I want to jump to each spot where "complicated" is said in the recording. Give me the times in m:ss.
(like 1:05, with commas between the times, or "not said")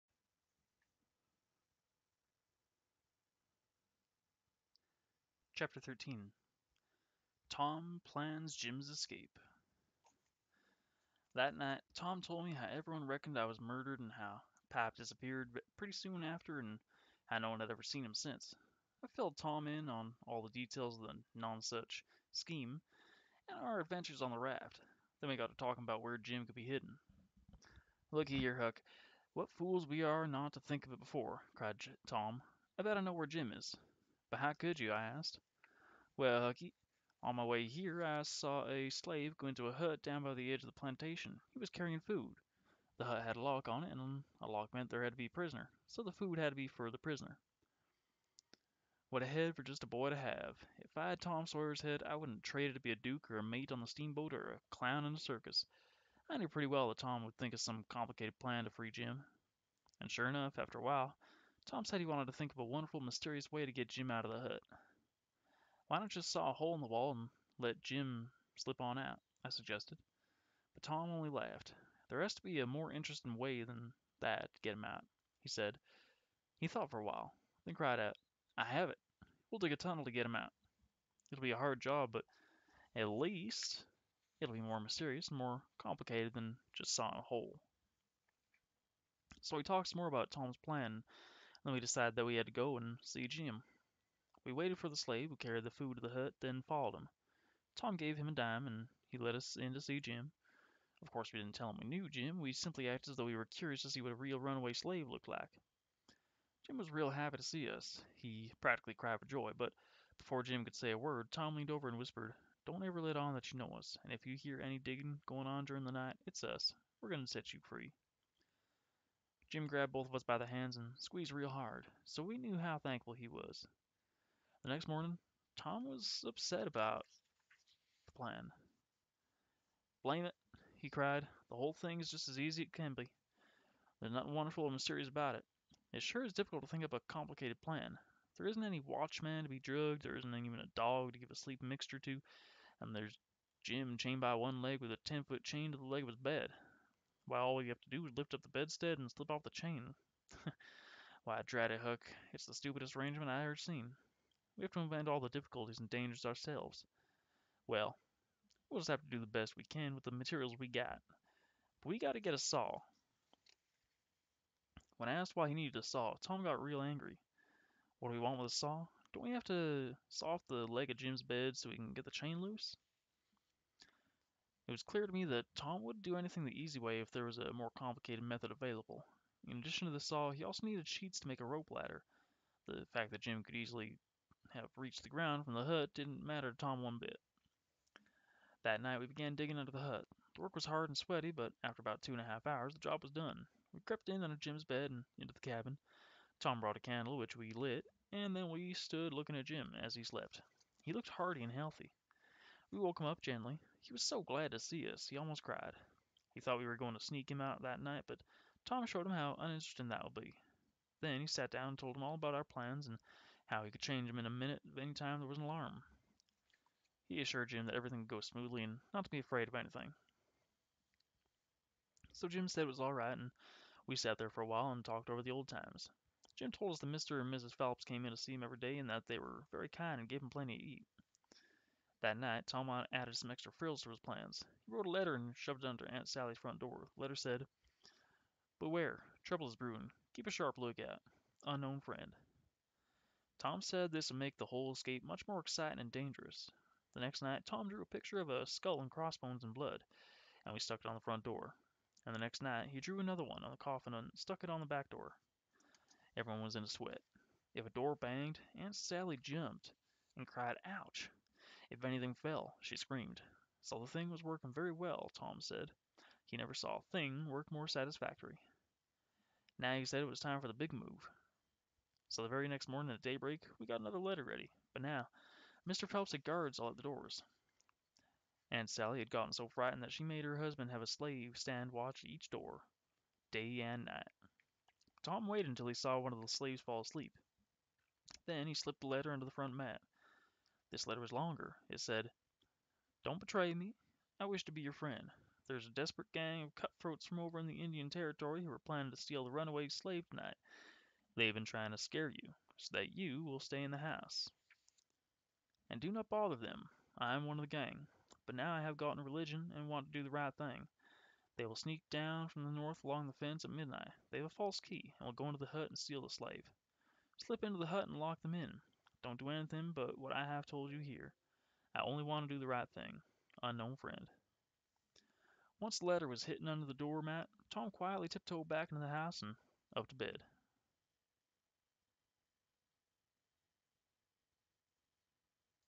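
0:57, 1:25, 2:17, 2:57.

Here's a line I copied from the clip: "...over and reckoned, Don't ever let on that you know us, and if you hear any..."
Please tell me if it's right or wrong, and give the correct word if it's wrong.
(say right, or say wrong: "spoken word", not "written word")
wrong: "whispered", not "reckoned".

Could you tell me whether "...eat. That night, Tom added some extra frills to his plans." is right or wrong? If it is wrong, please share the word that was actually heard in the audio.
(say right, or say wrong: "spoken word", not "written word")
right.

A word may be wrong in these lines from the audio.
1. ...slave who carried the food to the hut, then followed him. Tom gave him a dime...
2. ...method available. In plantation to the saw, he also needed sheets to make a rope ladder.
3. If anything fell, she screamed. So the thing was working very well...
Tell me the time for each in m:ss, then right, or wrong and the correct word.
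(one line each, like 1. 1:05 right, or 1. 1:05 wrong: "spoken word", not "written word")
1. 1:34 right
2. 2:58 wrong: "addition", not "plantation"
3. 4:21 right.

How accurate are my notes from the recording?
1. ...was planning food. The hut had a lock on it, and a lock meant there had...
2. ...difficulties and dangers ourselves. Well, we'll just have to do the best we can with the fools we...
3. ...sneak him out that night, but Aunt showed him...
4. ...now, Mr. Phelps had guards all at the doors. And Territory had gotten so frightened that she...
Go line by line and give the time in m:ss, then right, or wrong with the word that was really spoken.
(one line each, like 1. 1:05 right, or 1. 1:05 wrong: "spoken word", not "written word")
1. 0:41 wrong: "carrying", not "planning"
2. 2:35 wrong: "materials", not "fools"
3. 3:26 wrong: "Tom", not "Aunt"
4. 4:34 wrong: "Sally", not "Territory".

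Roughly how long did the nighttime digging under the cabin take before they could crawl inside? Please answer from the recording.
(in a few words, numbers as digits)
2 and a half hours.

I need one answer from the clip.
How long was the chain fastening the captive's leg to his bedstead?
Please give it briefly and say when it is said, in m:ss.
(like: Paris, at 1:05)
10 feet, at 2:25.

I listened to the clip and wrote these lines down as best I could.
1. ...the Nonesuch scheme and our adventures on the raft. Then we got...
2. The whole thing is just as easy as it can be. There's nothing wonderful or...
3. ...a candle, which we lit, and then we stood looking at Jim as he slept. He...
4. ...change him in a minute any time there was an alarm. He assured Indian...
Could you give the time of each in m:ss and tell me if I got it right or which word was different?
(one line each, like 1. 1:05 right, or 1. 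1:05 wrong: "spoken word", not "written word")
1. 0:21 right
2. 2:11 right
3. 3:16 right
4. 3:33 wrong: "Jim", not "Indian".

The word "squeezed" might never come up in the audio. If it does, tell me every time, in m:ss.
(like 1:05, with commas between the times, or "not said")
2:00.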